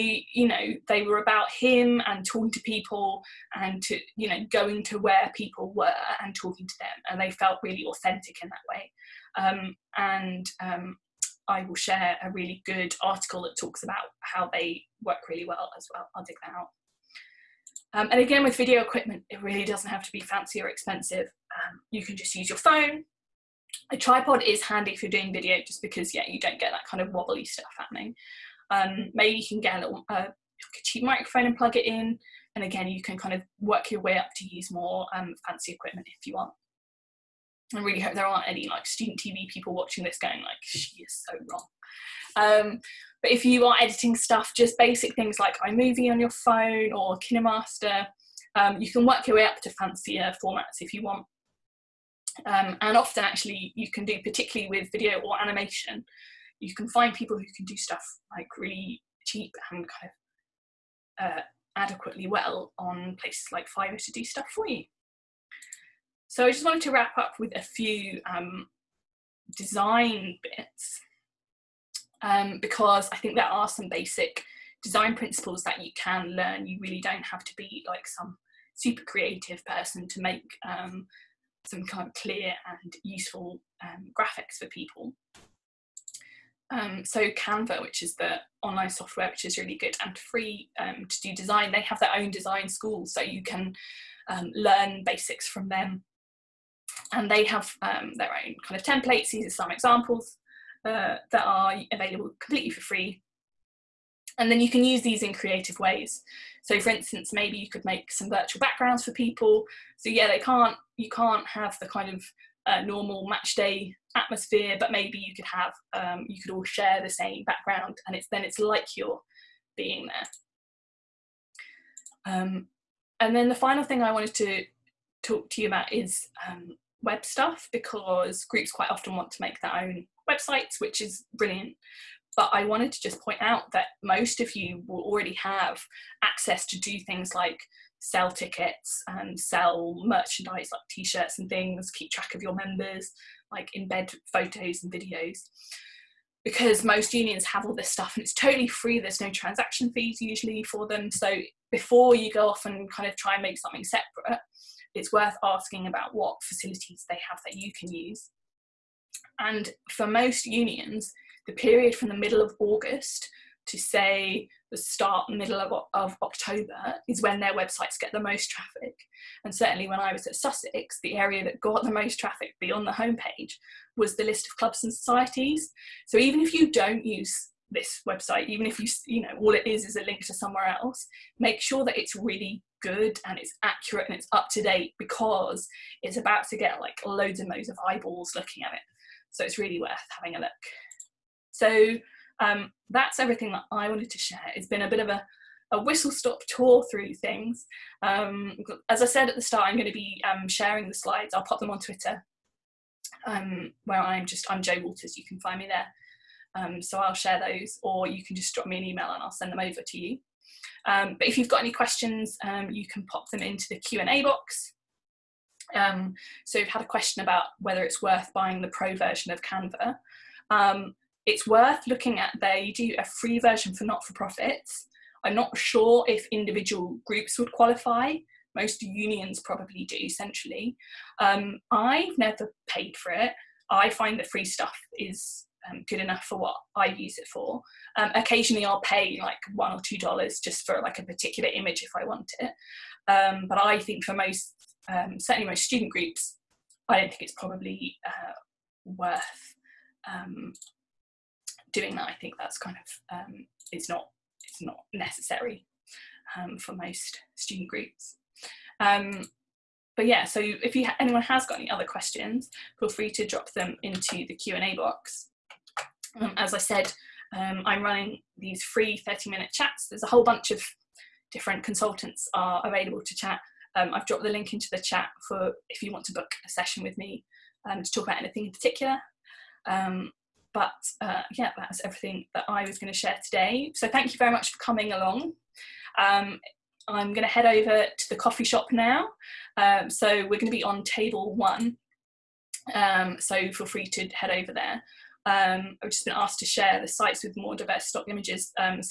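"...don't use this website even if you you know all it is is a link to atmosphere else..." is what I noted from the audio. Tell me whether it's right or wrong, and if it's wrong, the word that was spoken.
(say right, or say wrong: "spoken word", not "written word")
wrong: "somewhere", not "atmosphere".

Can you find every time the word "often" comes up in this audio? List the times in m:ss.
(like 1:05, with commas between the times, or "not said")
0:52, 2:08.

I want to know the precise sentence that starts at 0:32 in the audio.
And again, you can kind of work your way up to use more um, fancy equipment if you want.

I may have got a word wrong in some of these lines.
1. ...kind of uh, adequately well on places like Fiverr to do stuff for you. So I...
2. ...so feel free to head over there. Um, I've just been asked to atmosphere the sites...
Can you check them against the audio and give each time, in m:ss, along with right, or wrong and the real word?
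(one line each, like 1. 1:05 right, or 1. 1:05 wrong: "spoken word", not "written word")
1. 0:59 right
2. 4:53 wrong: "share", not "atmosphere".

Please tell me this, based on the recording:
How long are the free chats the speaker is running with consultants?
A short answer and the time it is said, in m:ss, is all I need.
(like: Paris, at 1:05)
30 minutes, at 4:29.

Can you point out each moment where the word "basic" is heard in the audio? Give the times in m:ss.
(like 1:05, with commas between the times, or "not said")
0:44, 1:13, 1:35.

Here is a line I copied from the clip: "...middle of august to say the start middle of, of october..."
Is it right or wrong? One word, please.
right.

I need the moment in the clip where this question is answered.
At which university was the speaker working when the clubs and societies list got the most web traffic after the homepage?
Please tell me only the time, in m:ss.
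2:50.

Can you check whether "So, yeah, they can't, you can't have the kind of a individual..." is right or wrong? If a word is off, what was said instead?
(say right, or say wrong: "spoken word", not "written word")
wrong: "normal", not "individual".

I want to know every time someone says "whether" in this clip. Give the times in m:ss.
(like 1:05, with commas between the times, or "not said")
3:37.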